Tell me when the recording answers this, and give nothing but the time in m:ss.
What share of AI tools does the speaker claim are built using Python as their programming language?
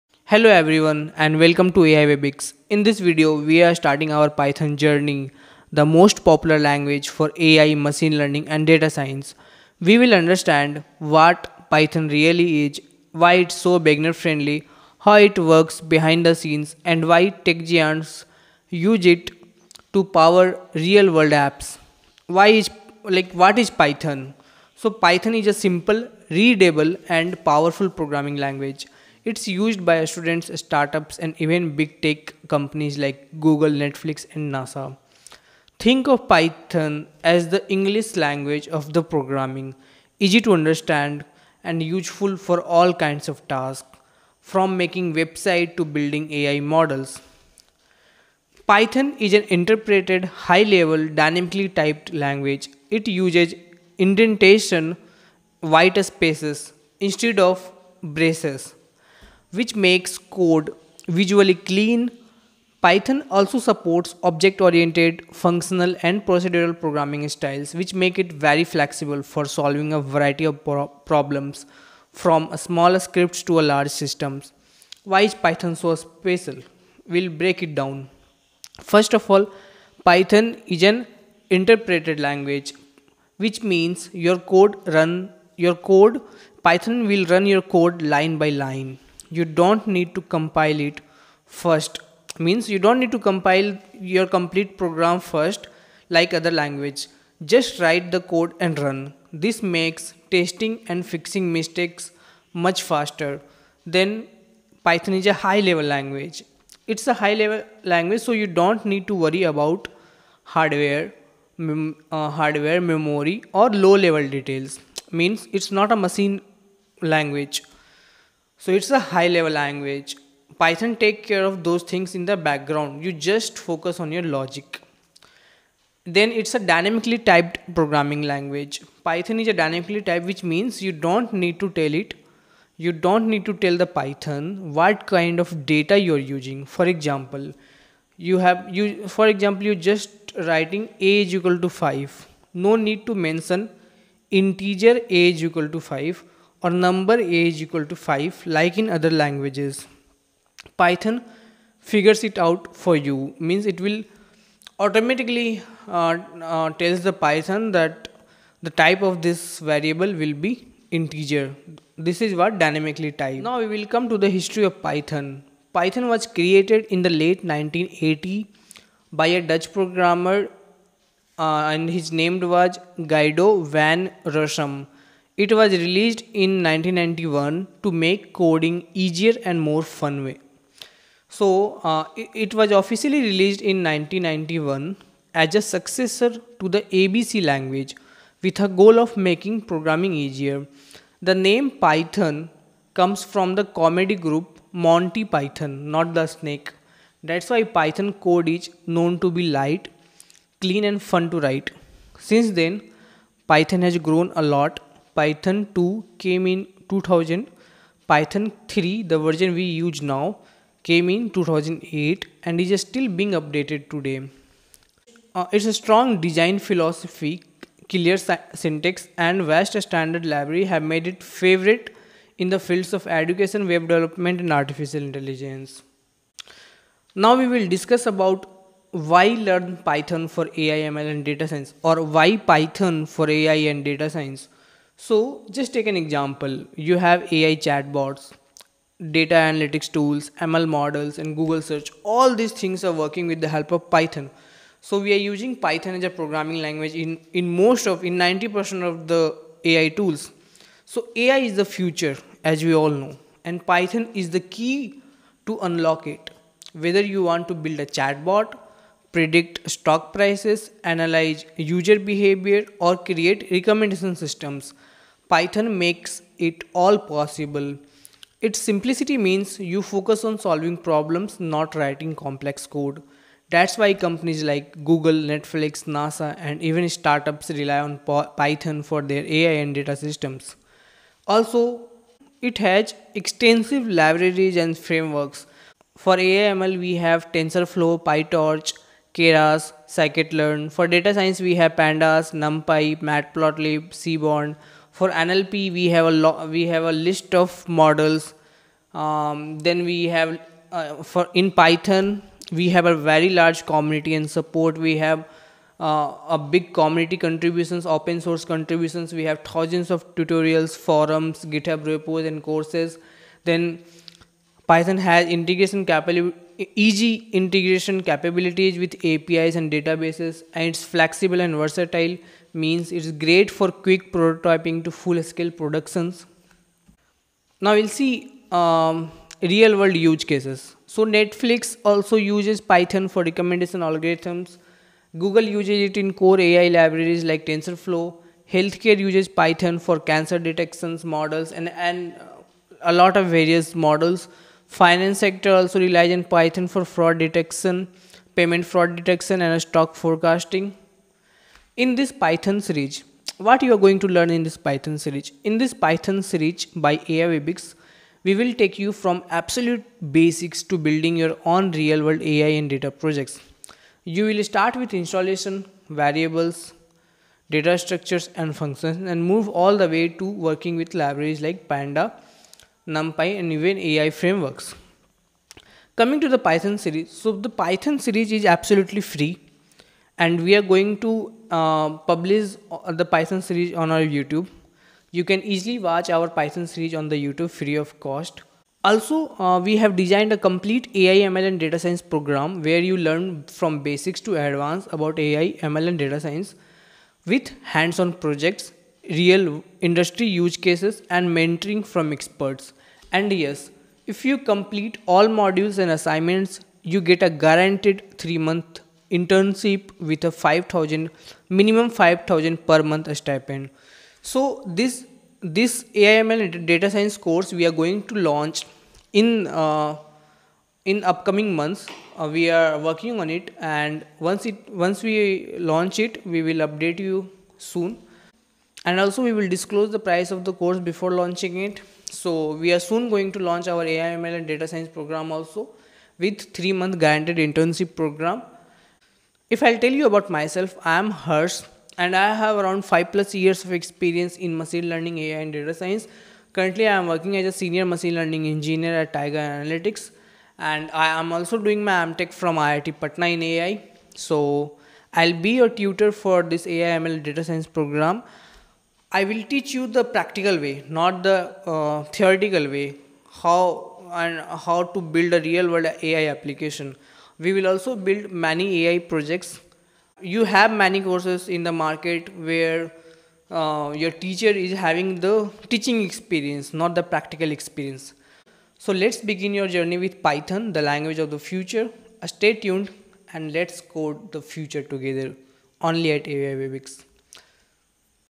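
4:08.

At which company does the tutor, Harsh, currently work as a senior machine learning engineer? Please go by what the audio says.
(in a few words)
Tiger Analytics.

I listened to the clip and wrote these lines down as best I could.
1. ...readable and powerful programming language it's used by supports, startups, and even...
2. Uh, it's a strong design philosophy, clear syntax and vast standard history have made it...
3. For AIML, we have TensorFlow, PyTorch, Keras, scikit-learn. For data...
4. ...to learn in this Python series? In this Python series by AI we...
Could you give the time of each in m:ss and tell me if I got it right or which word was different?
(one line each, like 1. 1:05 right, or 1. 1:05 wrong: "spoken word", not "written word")
1. 0:26 wrong: "students", not "supports"
2. 3:35 wrong: "library", not "history"
3. 4:45 right
4. 5:53 right.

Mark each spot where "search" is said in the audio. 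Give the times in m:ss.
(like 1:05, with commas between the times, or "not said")
4:01.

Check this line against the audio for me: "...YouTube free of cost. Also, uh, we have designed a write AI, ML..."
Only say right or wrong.
wrong.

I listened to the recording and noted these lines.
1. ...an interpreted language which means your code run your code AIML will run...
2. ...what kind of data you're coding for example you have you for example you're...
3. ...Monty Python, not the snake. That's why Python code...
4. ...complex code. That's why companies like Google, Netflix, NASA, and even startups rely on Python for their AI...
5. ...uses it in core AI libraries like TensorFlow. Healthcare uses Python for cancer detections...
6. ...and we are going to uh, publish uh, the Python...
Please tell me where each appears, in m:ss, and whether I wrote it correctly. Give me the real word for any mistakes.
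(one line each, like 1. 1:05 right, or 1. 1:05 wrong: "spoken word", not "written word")
1. 1:20 wrong: "Python", not "AIML"
2. 2:14 wrong: "using", not "coding"
3. 3:14 right
4. 4:32 right
5. 5:35 right
6. 6:20 right.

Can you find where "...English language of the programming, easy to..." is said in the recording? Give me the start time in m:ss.
0:37.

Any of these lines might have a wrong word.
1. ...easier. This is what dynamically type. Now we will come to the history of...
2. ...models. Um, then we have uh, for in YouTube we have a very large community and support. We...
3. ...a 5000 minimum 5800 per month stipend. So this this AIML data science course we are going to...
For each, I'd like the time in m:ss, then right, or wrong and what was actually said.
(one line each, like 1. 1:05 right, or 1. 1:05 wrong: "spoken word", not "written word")
1. 2:40 wrong: "integer", not "easier"
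2. 4:57 wrong: "Python", not "YouTube"
3. 6:50 wrong: "5000", not "5800".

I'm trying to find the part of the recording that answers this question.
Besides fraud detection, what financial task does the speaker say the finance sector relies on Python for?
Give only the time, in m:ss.
5:49.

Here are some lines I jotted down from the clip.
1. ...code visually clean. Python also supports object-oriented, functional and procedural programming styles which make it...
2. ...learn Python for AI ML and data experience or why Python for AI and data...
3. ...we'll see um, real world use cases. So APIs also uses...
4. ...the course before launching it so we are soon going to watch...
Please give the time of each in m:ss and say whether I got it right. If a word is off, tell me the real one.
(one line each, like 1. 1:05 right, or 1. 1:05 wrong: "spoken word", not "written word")
1. 1:00 right
2. 3:49 wrong: "science", not "experience"
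3. 5:27 wrong: "Netflix", not "APIs"
4. 7:10 wrong: "launch", not "watch".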